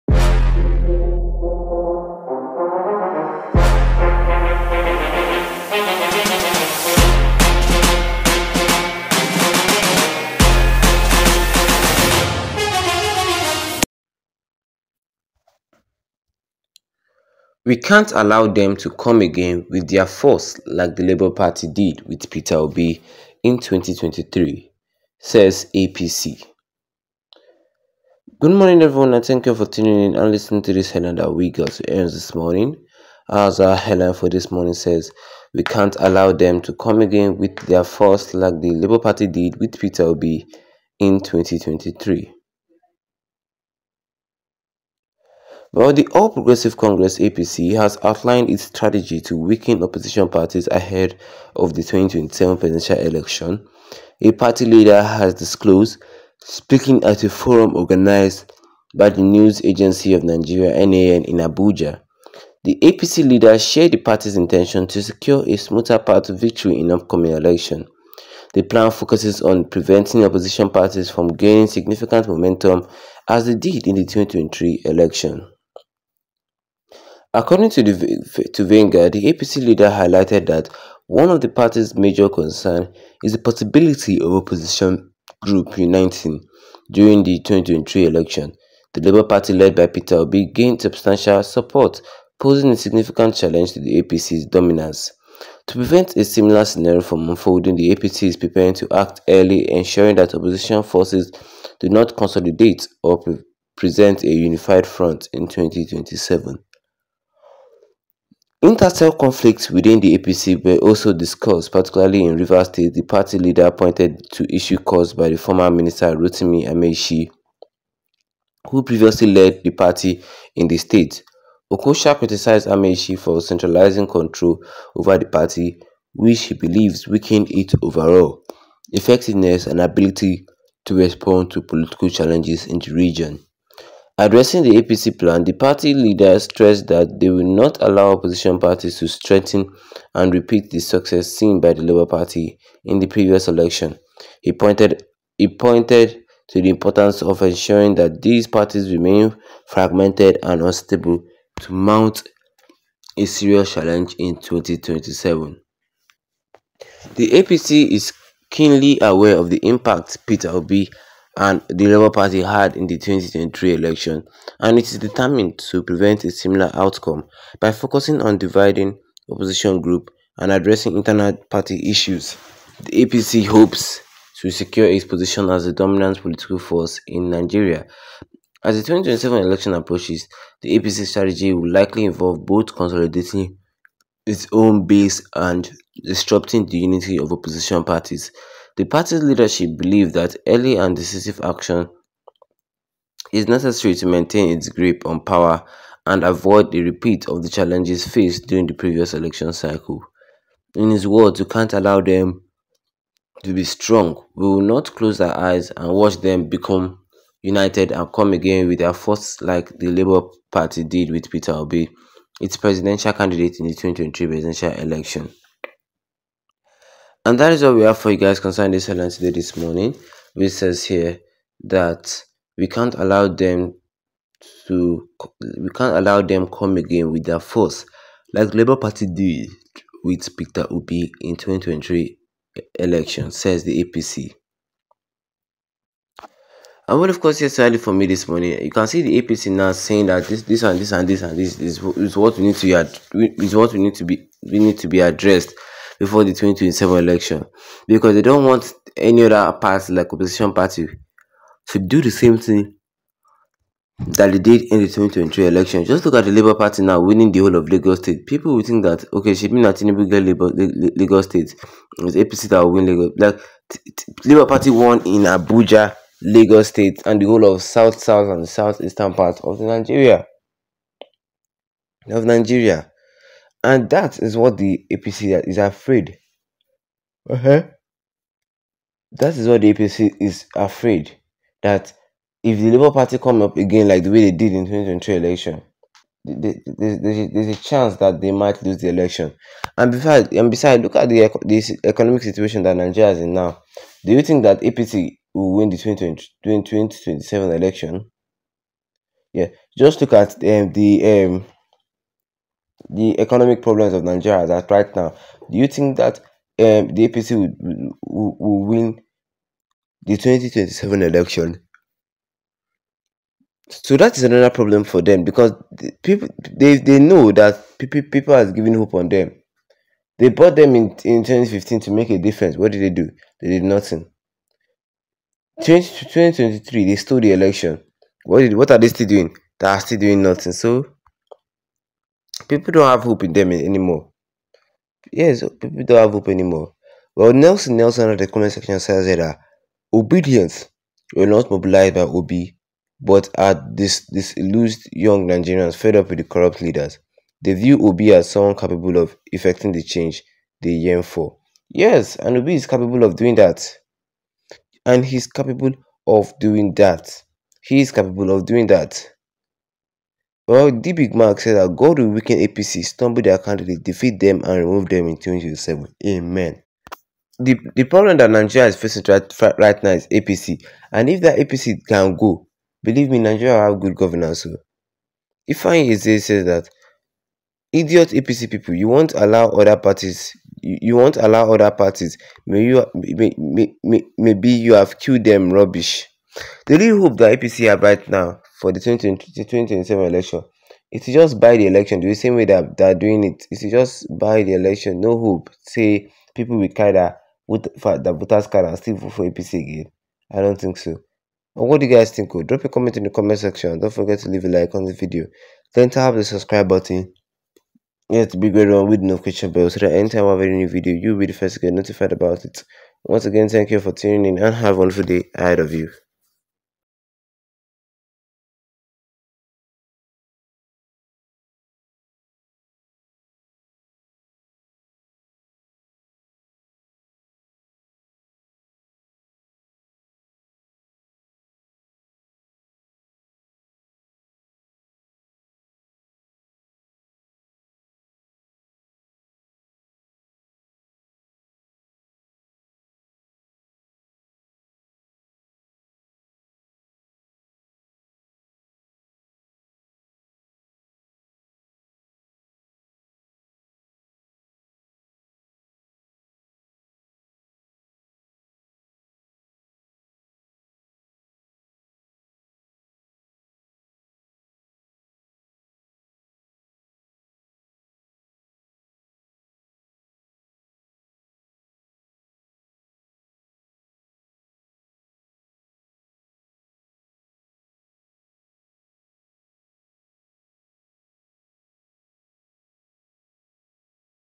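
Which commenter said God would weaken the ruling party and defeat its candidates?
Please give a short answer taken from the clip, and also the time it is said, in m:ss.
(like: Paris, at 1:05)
D. big Mark, at 6:00.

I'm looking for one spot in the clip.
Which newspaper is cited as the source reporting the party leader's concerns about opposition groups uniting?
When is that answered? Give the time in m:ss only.
1:18.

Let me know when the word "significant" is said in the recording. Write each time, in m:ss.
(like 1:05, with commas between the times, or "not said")
1:11, 1:32.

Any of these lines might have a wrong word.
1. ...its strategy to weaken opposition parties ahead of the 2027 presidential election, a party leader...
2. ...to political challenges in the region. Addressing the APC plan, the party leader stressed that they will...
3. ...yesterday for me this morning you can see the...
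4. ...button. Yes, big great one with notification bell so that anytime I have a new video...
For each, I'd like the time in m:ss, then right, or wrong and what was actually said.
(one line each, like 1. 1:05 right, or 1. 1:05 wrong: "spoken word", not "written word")
1. 0:48 right
2. 2:11 right
3. 3:57 right
4. 6:46 right.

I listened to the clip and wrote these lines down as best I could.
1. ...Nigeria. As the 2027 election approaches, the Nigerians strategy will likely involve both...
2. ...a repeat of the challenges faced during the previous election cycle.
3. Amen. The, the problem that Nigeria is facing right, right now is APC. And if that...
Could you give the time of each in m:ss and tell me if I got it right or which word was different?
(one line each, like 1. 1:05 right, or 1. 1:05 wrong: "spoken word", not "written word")
1. 2:57 wrong: "APC", not "Nigerians"
2. 3:16 right
3. 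6:06 right.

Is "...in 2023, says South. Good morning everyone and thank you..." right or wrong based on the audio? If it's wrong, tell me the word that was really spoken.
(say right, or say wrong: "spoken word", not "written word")
wrong: "APC", not "South".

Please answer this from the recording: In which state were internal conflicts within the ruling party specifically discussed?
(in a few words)
Rivers State.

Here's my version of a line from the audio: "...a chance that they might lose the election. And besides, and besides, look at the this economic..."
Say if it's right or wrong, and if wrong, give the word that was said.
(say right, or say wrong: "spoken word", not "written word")
right.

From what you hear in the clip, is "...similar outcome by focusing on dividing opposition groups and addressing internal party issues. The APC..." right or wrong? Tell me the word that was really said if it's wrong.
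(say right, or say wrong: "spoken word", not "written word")
right.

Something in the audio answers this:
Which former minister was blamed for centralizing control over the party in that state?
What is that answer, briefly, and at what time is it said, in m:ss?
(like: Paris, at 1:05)
Rotimi Amaechi, at 1:56.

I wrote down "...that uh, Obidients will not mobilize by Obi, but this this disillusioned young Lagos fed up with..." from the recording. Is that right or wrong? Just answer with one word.
wrong.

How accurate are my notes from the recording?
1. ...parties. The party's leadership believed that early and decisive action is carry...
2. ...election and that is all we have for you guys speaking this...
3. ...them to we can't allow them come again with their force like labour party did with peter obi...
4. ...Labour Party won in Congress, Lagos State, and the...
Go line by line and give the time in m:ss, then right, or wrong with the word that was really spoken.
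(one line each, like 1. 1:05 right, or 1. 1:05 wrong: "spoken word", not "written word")
1. 3:07 wrong: "necessary", not "carry"
2. 3:34 wrong: "concerning", not "speaking"
3. 3:43 right
4. 4:24 wrong: "Abuja", not "Congress".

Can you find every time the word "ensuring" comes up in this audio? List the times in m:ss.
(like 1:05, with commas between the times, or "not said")
1:39, 2:27.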